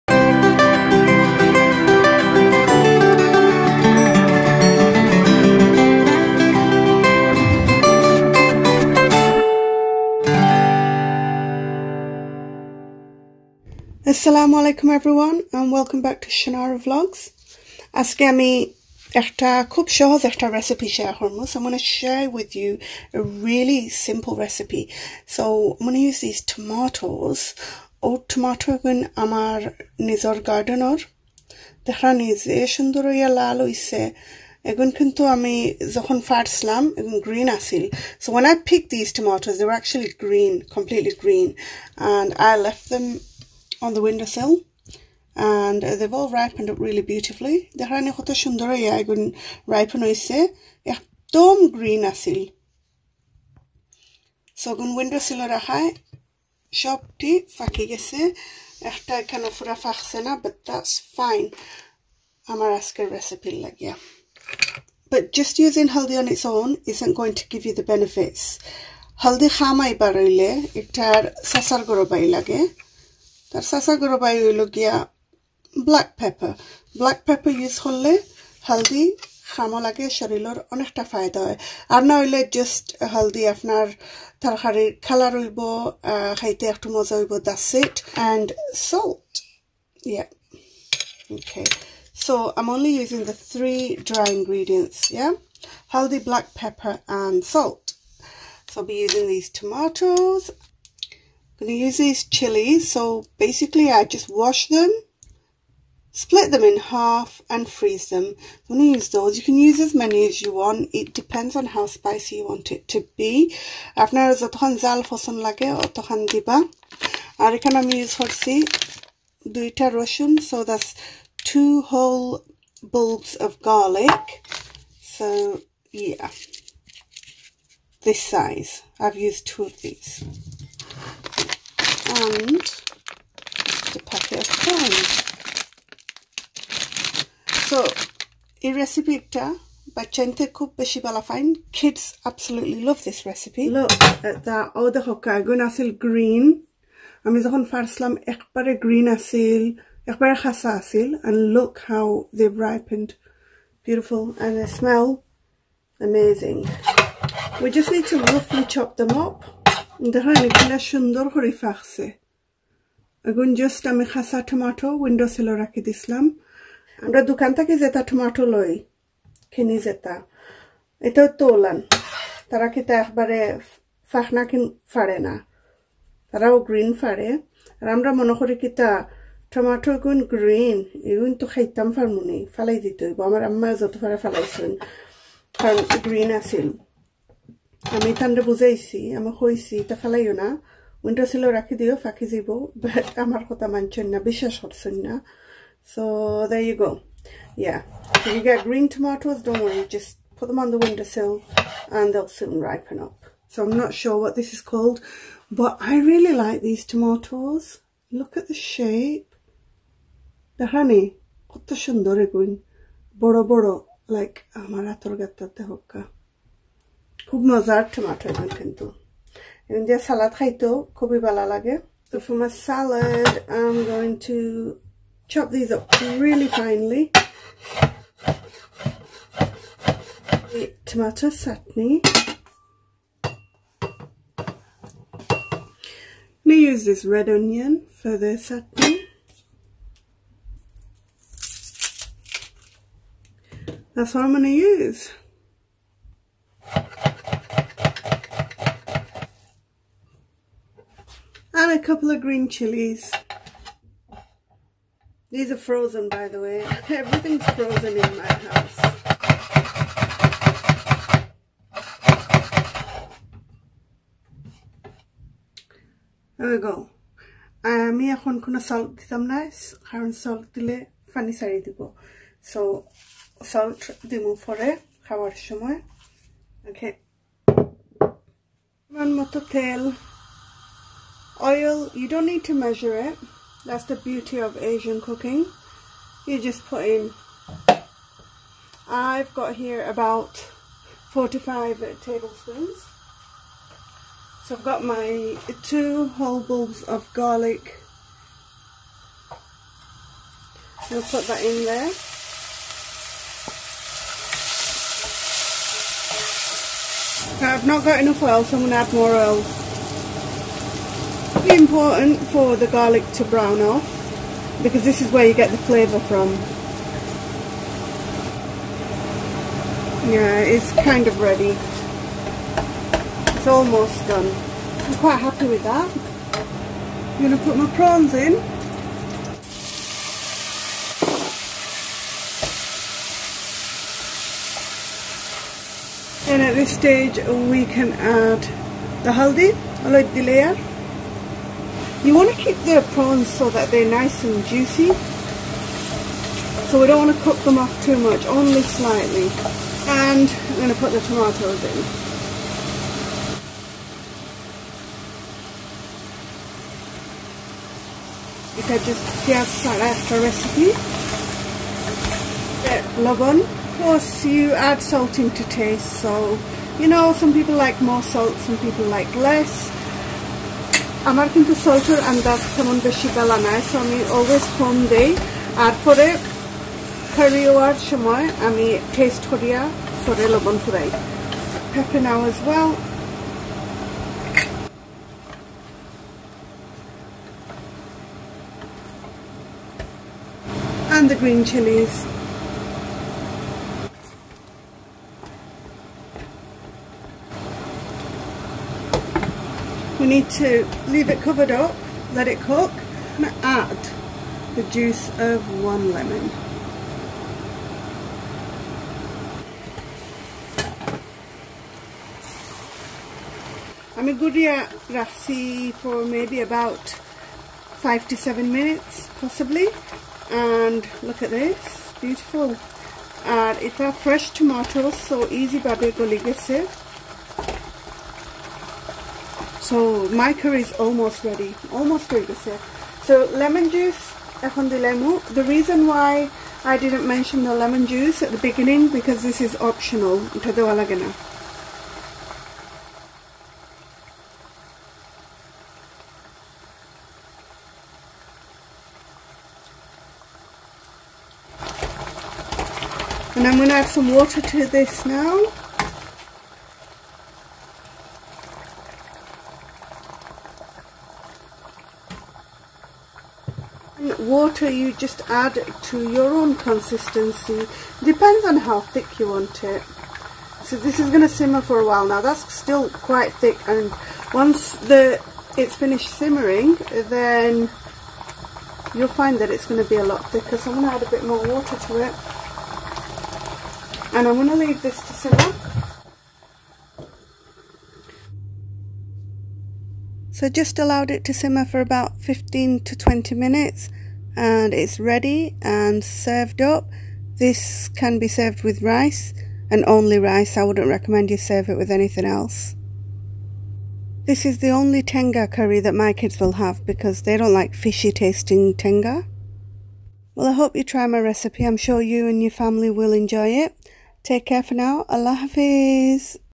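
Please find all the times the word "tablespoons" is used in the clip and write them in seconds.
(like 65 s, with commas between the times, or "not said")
292 s.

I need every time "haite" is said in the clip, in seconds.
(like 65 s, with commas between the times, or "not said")
86 s.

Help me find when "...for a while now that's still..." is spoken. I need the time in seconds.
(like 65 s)
471 s.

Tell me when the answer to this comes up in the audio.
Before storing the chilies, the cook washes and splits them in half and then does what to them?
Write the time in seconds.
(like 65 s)
107 s.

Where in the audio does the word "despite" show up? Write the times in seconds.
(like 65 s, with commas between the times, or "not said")
not said.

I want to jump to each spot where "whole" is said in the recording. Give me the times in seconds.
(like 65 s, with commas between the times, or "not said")
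121 s, 296 s.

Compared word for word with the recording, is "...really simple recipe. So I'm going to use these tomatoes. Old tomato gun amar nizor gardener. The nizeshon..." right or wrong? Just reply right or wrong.
right.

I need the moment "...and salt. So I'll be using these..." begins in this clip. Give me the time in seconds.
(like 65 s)
97 s.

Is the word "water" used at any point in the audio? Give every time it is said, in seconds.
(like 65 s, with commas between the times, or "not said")
454 s, 464 s, 481 s.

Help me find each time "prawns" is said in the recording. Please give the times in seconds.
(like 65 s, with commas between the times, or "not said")
327 s, 342 s.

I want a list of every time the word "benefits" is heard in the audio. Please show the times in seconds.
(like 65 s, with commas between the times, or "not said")
67 s.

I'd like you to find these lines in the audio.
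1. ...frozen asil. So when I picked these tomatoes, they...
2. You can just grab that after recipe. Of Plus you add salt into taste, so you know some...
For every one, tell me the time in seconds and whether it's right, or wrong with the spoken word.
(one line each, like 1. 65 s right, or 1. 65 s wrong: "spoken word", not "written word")
1. 37 s wrong: "green", not "frozen"
2. 358 s right.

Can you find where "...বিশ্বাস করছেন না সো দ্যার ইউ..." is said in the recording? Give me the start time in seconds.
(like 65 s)
194 s.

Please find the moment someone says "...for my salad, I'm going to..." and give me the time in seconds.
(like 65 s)
222 s.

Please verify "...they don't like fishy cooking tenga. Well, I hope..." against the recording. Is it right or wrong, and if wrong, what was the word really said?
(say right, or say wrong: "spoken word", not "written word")
wrong: "tasting", not "cooking".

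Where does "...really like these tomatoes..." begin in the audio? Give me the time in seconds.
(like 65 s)
206 s.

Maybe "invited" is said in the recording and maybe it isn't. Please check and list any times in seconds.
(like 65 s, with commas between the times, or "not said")
not said.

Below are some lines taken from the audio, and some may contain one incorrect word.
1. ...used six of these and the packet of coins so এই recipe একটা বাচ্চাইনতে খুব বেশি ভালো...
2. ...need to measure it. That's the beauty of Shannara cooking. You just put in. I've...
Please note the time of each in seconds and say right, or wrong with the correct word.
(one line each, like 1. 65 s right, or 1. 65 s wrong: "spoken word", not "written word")
1. 129 s wrong: "two", not "six"
2. 282 s wrong: "Asian", not "Shannara".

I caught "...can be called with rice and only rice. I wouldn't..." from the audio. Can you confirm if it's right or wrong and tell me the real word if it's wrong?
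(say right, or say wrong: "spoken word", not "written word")
wrong: "served", not "called".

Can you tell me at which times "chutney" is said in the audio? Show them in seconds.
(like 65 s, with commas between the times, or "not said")
231 s, 238 s.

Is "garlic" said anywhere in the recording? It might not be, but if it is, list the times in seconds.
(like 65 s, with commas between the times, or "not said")
123 s, 297 s, 312 s.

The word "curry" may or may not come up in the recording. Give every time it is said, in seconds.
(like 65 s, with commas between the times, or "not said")
430 s, 505 s.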